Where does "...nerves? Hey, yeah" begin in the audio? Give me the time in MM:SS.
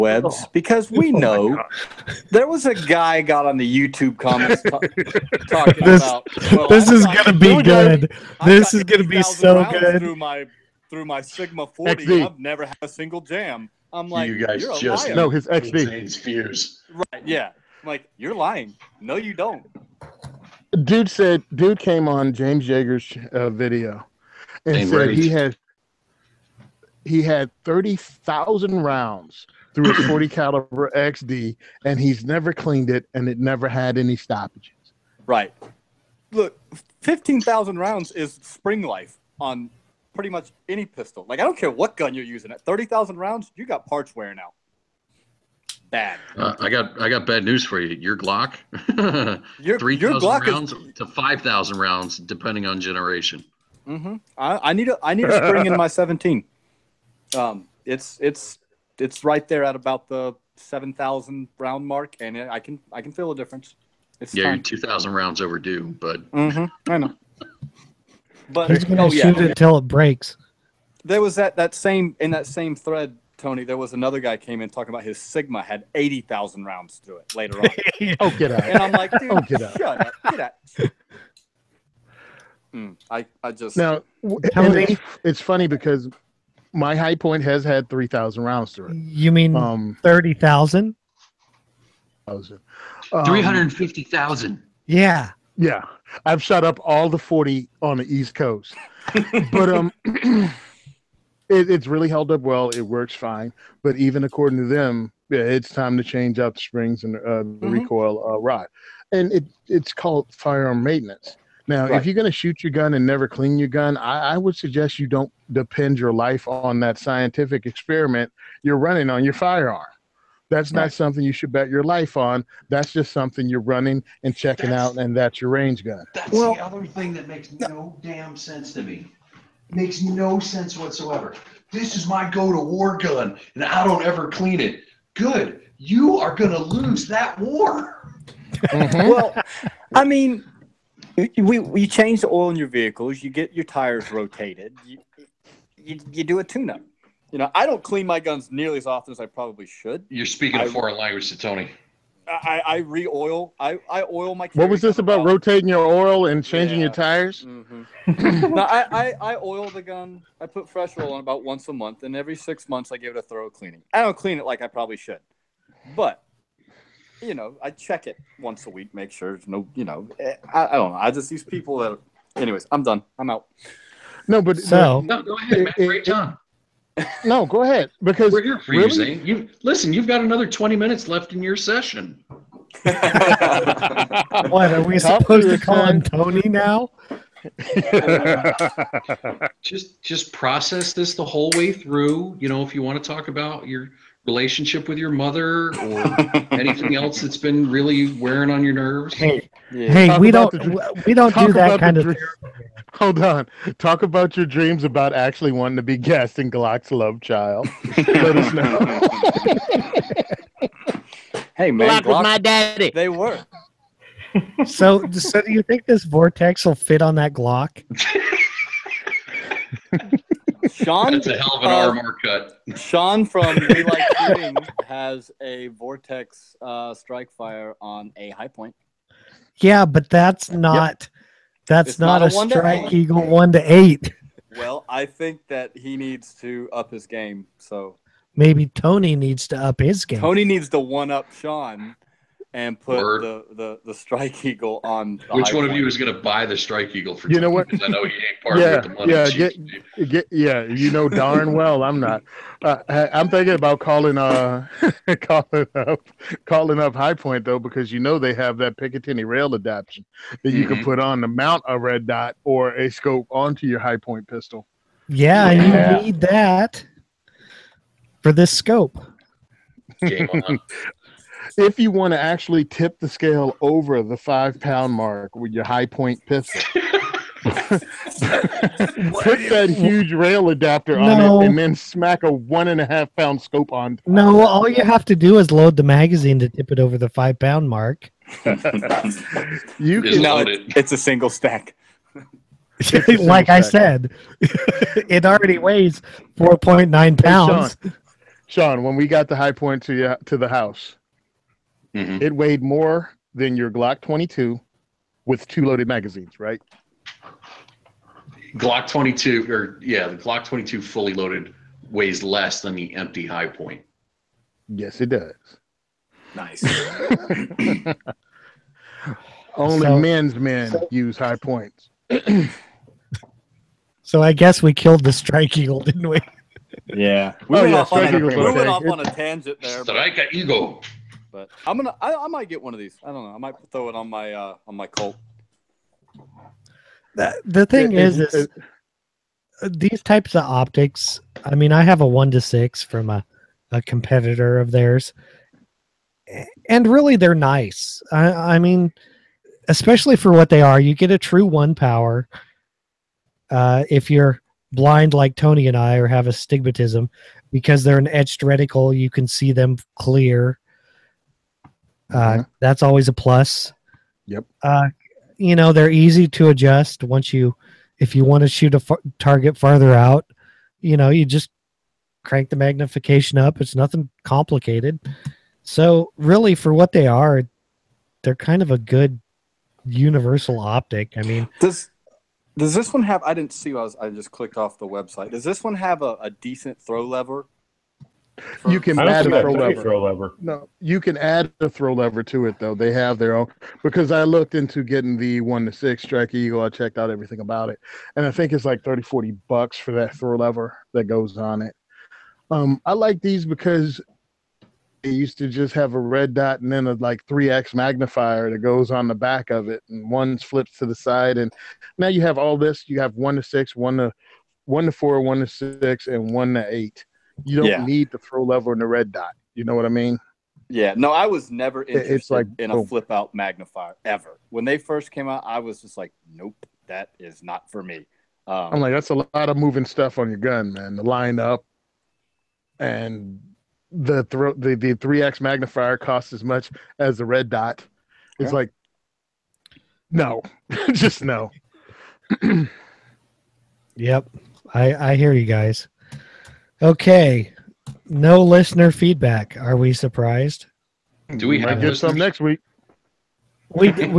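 03:18.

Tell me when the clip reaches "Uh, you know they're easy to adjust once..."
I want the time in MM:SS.
06:04.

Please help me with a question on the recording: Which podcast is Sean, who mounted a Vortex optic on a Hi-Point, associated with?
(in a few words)
We Like Shooting.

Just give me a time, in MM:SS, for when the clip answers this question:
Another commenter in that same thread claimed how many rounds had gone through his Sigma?
01:15.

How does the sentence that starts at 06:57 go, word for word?
need the throw lever and the red dot.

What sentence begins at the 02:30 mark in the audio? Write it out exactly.
You're speaking I, a foreign language to Tony.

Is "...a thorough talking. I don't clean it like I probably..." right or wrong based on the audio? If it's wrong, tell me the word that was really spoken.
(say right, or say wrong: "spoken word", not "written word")
wrong: "cleaning", not "talking".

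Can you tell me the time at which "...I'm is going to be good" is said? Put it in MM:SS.
00:06.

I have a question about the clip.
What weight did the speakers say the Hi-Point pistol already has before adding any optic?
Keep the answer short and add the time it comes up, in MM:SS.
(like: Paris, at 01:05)
4.9 pounds, at 04:56.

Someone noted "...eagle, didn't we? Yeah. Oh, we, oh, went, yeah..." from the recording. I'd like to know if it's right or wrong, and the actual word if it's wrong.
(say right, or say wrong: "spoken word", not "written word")
right.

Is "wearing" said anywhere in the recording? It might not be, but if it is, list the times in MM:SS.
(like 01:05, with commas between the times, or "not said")
00:44, 03:18.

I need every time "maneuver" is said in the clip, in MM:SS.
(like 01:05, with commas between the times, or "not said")
not said.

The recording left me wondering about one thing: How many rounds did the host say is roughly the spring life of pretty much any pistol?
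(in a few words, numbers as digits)
15,000.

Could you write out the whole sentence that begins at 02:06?
That's well, the other thing that makes no, no damn sense to me.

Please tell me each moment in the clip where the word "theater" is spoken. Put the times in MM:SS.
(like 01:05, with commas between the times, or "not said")
not said.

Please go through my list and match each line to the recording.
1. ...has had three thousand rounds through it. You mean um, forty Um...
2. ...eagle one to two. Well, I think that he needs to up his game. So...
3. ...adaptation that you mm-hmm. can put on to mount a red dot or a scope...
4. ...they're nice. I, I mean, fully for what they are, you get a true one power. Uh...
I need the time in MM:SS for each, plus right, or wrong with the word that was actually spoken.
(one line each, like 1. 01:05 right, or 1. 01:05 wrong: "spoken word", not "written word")
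1. 01:27 wrong: "thirty", not "forty"
2. 03:52 wrong: "eight", not "two"
3. 04:19 right
4. 05:47 wrong: "especially", not "fully".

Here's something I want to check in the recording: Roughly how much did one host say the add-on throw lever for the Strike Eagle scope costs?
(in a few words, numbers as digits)
30 to 40 dollars.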